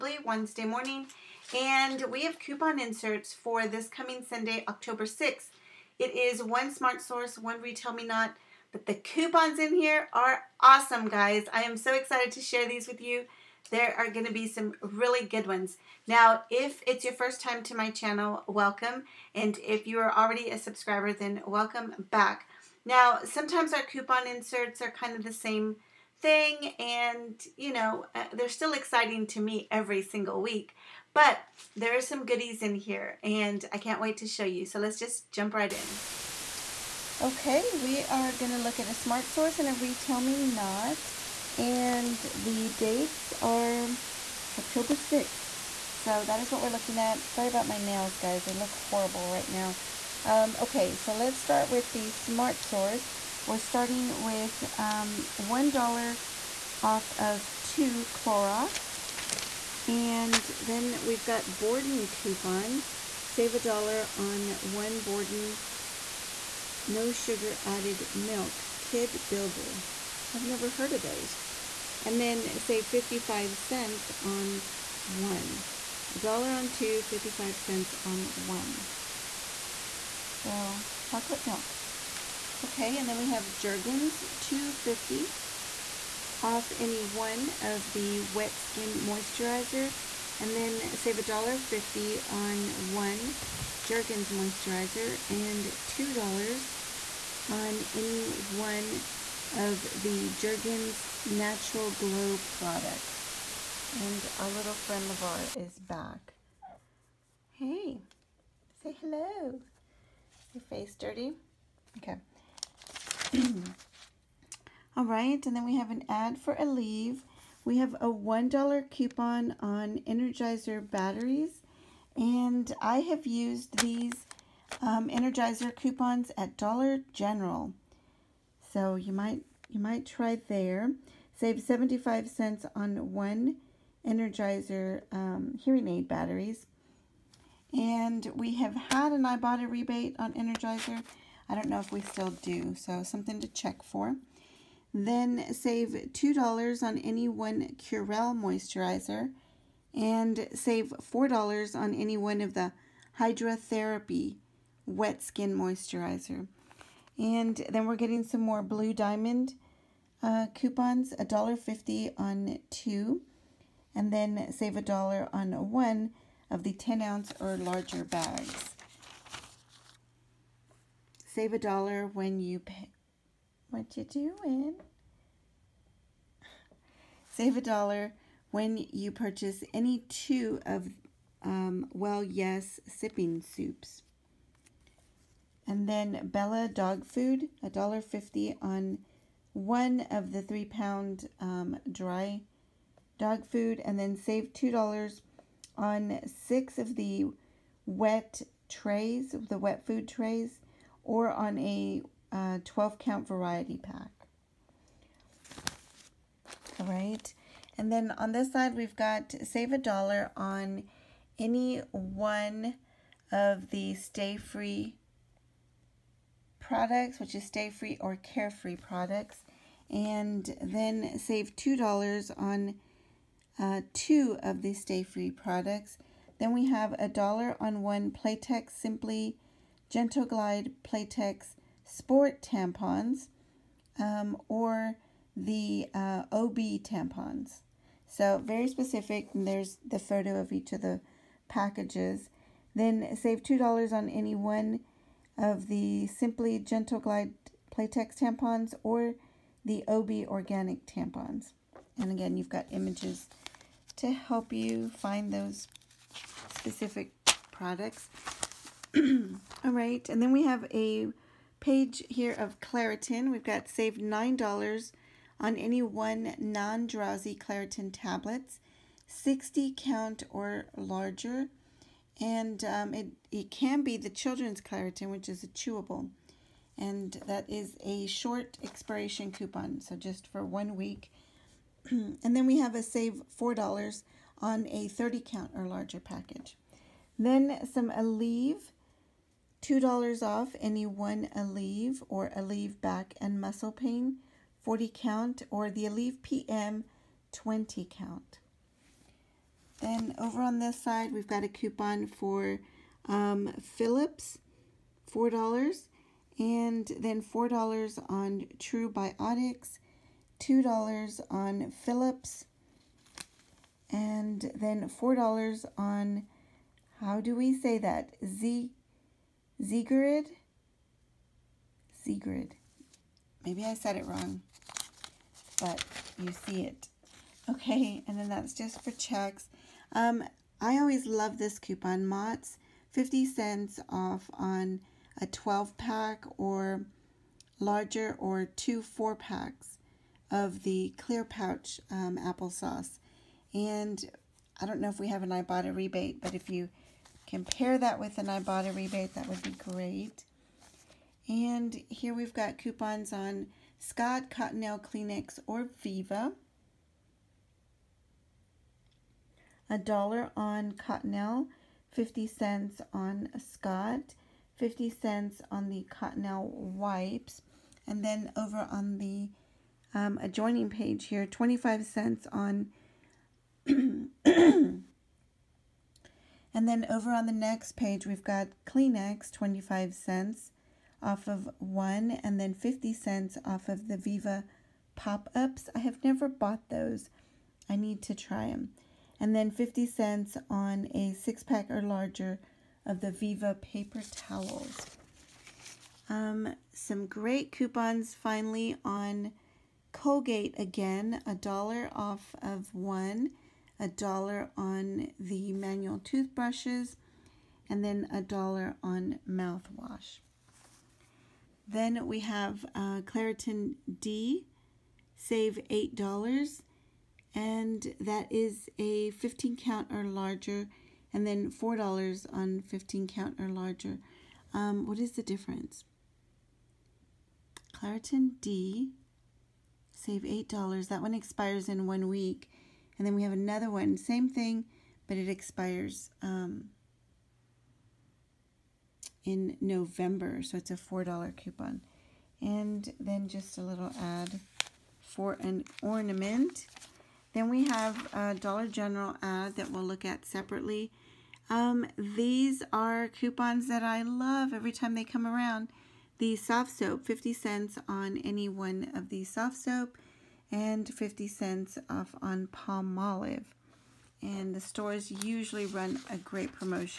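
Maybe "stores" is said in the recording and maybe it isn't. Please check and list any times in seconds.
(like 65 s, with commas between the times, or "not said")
464 s.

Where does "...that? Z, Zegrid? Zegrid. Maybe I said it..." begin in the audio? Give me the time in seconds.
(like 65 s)
317 s.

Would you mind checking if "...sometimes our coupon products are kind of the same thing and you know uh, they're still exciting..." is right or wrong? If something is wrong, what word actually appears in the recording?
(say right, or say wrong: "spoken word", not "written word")
wrong: "inserts", not "products".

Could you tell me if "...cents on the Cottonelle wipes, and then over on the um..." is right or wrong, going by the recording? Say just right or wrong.
right.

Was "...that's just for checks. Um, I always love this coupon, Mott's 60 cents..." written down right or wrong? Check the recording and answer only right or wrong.
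wrong.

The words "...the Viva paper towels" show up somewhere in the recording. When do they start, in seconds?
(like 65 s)
393 s.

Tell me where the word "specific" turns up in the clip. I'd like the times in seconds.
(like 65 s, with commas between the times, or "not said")
238 s, 256 s.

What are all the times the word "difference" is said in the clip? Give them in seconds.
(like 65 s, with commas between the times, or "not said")
425 s.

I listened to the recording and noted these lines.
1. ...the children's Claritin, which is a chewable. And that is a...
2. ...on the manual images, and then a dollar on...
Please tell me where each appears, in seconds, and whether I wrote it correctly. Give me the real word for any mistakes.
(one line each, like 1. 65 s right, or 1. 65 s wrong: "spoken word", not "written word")
1. 273 s right
2. 404 s wrong: "toothbrushes", not "images".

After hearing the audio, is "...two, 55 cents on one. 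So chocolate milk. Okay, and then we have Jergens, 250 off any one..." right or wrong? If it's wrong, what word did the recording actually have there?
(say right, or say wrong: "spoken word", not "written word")
right.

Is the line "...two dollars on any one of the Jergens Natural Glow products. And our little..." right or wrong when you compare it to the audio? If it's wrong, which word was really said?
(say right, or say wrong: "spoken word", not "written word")
right.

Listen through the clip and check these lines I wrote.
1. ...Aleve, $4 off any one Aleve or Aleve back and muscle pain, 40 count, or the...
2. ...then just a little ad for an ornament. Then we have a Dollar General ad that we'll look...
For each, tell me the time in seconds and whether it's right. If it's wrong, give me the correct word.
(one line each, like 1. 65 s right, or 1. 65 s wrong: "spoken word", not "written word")
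1. 287 s wrong: "2", not "4"
2. 442 s right.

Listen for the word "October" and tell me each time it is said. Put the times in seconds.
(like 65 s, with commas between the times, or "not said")
4 s, 44 s.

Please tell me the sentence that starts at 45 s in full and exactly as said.
So that is what we're looking at.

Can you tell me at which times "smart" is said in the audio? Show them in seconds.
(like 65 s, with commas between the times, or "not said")
6 s, 38 s, 52 s.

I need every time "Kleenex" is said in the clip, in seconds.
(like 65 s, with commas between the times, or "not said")
354 s, 378 s.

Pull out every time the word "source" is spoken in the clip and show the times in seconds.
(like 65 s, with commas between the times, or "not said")
7 s, 39 s, 52 s.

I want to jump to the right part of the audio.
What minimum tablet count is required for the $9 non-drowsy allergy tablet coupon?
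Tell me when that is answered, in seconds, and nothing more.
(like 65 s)
269 s.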